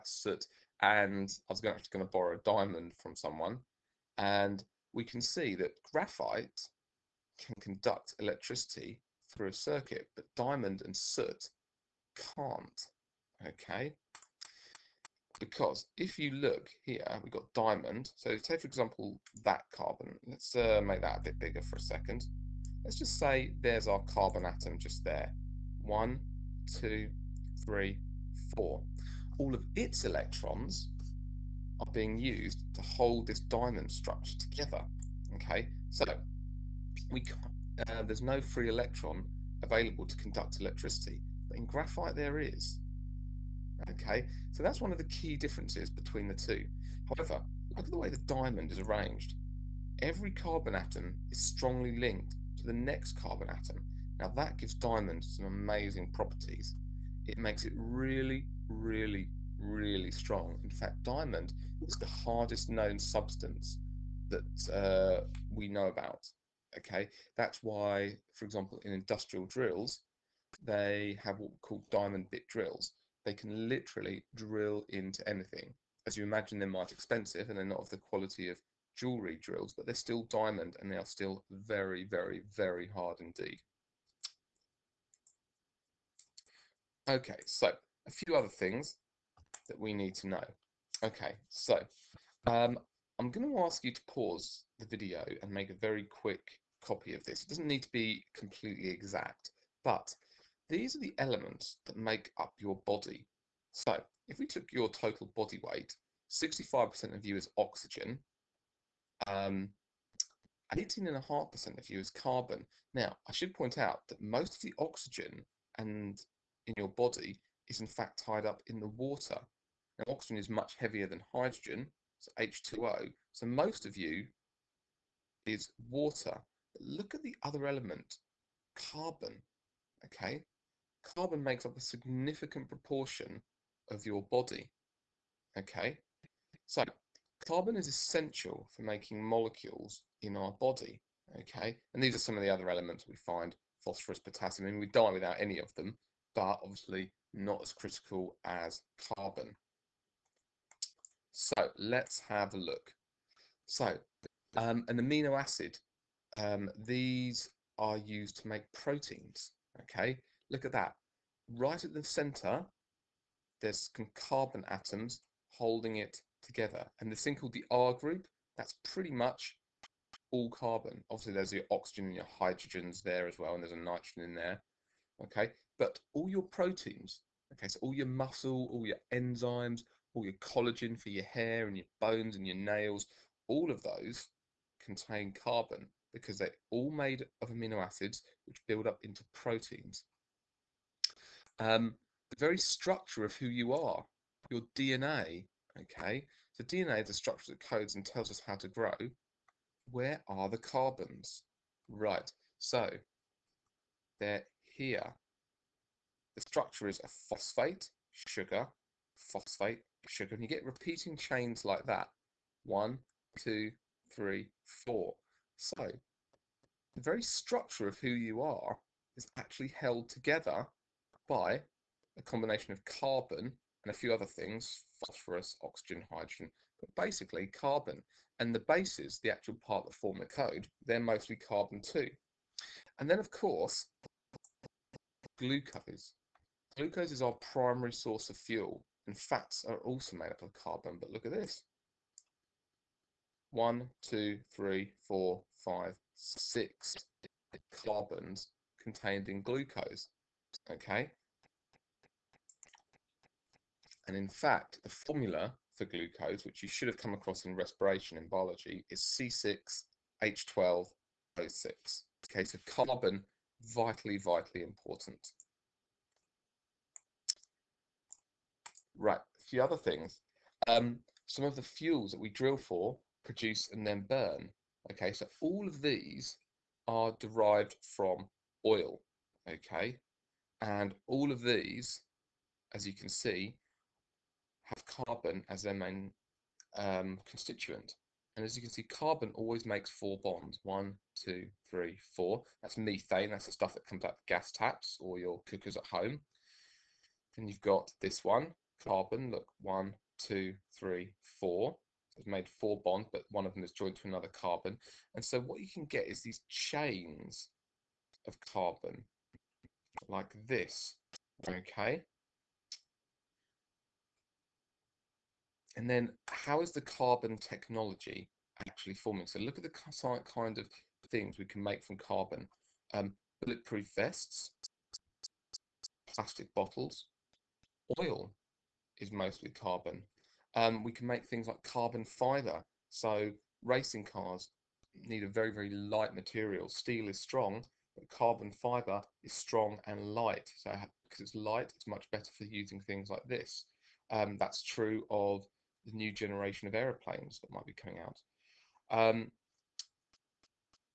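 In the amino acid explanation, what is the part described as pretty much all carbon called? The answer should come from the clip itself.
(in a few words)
R group.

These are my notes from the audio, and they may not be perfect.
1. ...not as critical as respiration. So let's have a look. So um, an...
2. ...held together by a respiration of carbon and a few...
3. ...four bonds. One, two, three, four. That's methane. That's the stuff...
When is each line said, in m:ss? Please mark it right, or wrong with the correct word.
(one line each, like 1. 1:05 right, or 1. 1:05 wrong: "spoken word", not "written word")
1. 2:27 wrong: "carbon", not "respiration"
2. 3:39 wrong: "combination", not "respiration"
3. 4:49 right.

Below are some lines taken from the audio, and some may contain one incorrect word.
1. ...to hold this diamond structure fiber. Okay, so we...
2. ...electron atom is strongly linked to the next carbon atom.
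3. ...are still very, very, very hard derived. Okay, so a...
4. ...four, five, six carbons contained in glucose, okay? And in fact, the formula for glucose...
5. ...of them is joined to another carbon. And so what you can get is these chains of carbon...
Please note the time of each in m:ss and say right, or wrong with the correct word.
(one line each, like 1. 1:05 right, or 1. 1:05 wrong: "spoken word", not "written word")
1. 0:32 wrong: "together", not "fiber"
2. 0:50 wrong: "carbon", not "electron"
3. 1:20 wrong: "indeed", not "derived"
4. 4:05 right
5. 5:03 right.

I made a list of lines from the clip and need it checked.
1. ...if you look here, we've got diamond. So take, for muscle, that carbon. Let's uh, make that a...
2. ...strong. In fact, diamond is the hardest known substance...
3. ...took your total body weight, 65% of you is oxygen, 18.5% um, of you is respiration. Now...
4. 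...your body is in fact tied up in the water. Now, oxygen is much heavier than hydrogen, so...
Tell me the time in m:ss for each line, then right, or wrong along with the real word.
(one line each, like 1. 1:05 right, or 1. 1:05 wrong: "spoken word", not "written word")
1. 0:15 wrong: "example", not "muscle"
2. 1:00 right
3. 1:44 wrong: "carbon", not "respiration"
4. 1:56 right.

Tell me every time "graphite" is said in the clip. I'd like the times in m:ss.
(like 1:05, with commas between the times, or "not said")
0:05, 0:41.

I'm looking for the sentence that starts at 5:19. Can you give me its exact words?
So look at the kind of things we can make from carbon.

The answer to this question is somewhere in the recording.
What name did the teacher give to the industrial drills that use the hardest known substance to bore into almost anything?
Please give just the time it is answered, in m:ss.
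1:11.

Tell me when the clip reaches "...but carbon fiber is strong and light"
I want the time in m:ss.
5:37.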